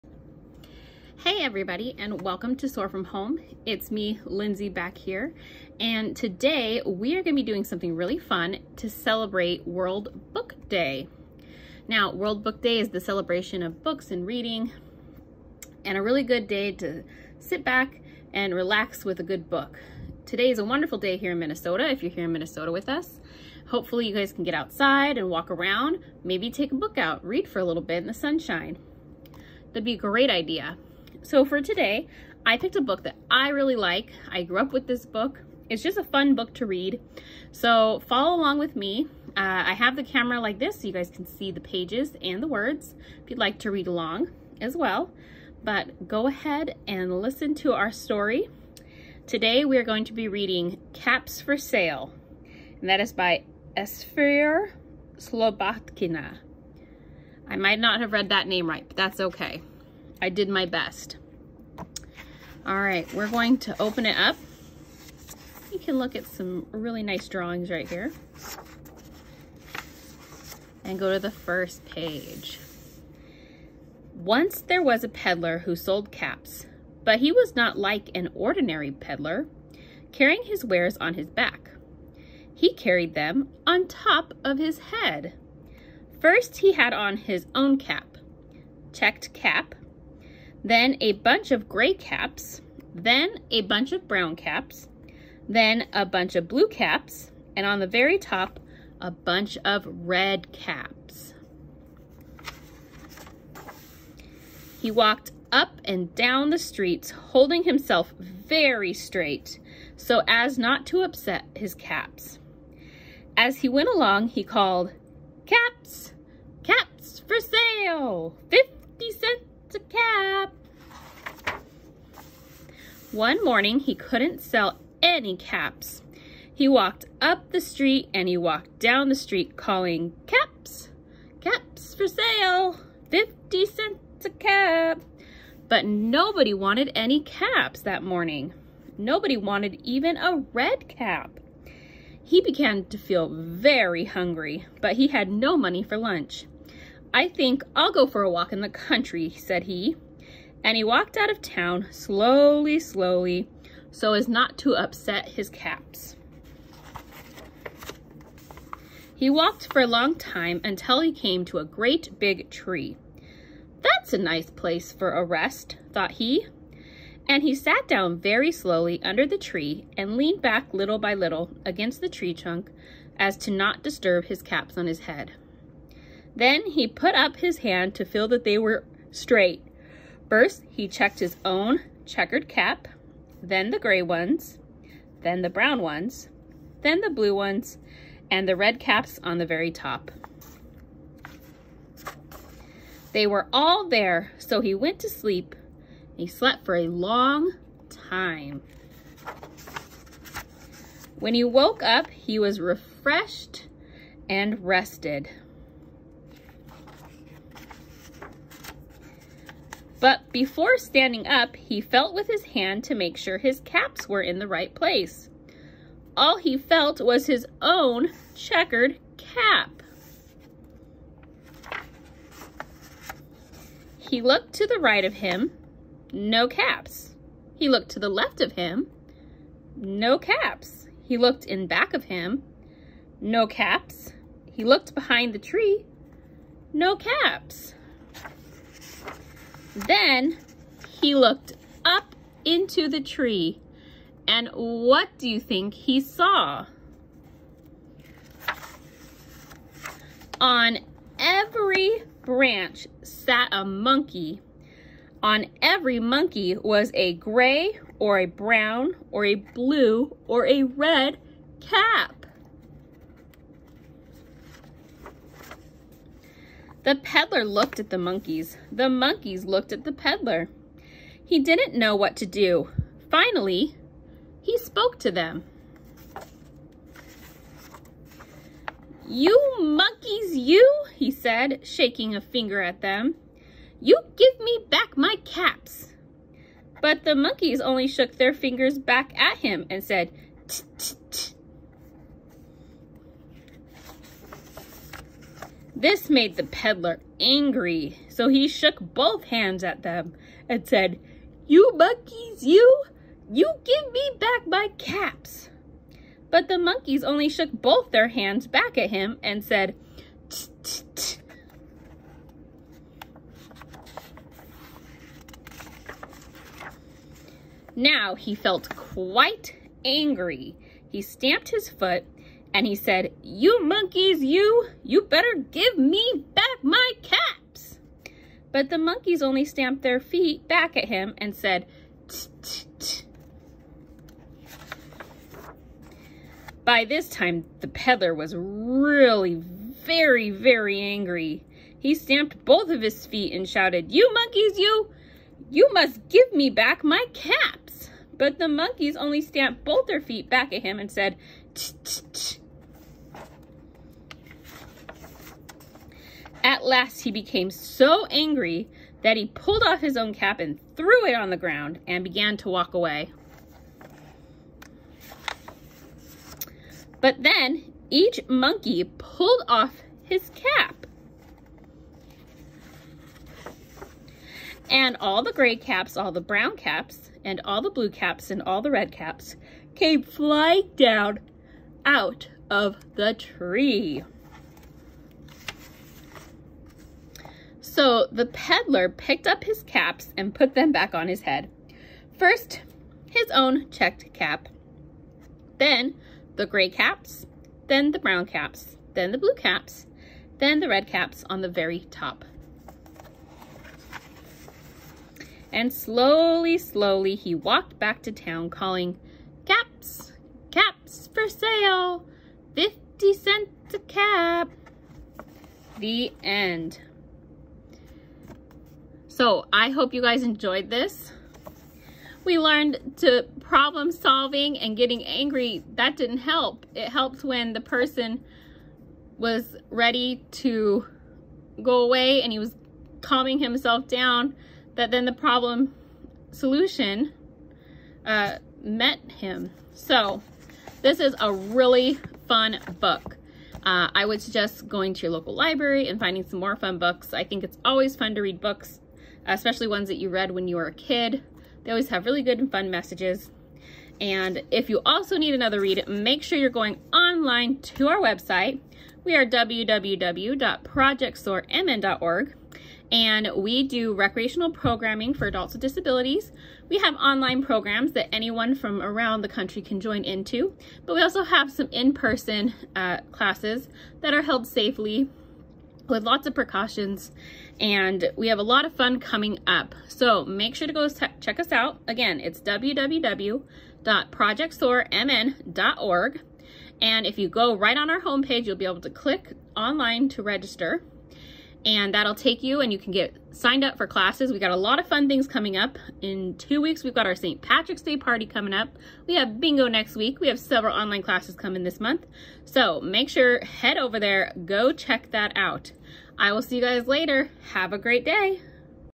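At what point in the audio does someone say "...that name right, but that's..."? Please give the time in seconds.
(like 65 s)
58 s.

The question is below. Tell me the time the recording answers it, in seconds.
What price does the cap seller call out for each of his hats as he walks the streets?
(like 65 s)
118 s.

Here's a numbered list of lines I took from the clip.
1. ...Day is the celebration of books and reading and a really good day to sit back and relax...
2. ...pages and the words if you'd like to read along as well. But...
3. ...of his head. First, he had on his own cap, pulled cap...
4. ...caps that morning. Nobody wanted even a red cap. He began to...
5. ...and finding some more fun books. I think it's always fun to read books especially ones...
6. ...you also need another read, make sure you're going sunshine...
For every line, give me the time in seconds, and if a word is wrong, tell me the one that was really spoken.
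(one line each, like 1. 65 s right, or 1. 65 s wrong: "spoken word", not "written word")
1. 12 s right
2. 41 s right
3. 84 s wrong: "checked", not "pulled"
4. 137 s right
5. 445 s right
6. 454 s wrong: "online", not "sunshine".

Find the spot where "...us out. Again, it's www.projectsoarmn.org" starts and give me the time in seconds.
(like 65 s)
481 s.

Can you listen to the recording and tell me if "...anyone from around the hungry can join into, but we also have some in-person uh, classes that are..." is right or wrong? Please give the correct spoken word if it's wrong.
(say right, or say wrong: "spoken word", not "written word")
wrong: "country", not "hungry".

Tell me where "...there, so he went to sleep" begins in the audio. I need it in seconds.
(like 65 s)
193 s.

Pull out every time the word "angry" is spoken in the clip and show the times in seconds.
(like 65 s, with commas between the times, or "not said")
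297 s, 319 s, 340 s, 358 s, 425 s.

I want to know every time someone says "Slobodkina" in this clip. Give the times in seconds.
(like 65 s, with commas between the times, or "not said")
55 s.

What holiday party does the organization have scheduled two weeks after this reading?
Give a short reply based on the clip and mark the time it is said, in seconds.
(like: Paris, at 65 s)
St. Patrick's Day party, at 497 s.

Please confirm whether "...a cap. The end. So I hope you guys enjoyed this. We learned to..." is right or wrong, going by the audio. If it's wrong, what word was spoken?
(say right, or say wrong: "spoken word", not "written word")
right.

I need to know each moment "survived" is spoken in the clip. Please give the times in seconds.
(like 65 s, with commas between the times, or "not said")
not said.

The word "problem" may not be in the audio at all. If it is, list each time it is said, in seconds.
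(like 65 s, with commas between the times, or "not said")
423 s, 435 s.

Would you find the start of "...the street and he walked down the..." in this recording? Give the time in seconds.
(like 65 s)
127 s.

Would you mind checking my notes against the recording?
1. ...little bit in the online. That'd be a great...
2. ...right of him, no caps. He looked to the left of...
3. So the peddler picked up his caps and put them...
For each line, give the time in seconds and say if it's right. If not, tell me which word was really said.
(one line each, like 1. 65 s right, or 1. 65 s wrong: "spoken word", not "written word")
1. 27 s wrong: "sunshine", not "online"
2. 224 s right
3. 387 s right.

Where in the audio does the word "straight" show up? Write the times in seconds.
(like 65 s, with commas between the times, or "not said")
108 s, 179 s.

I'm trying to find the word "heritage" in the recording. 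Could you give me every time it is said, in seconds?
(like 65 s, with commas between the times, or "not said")
not said.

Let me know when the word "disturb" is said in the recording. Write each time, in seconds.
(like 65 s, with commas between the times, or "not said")
173 s.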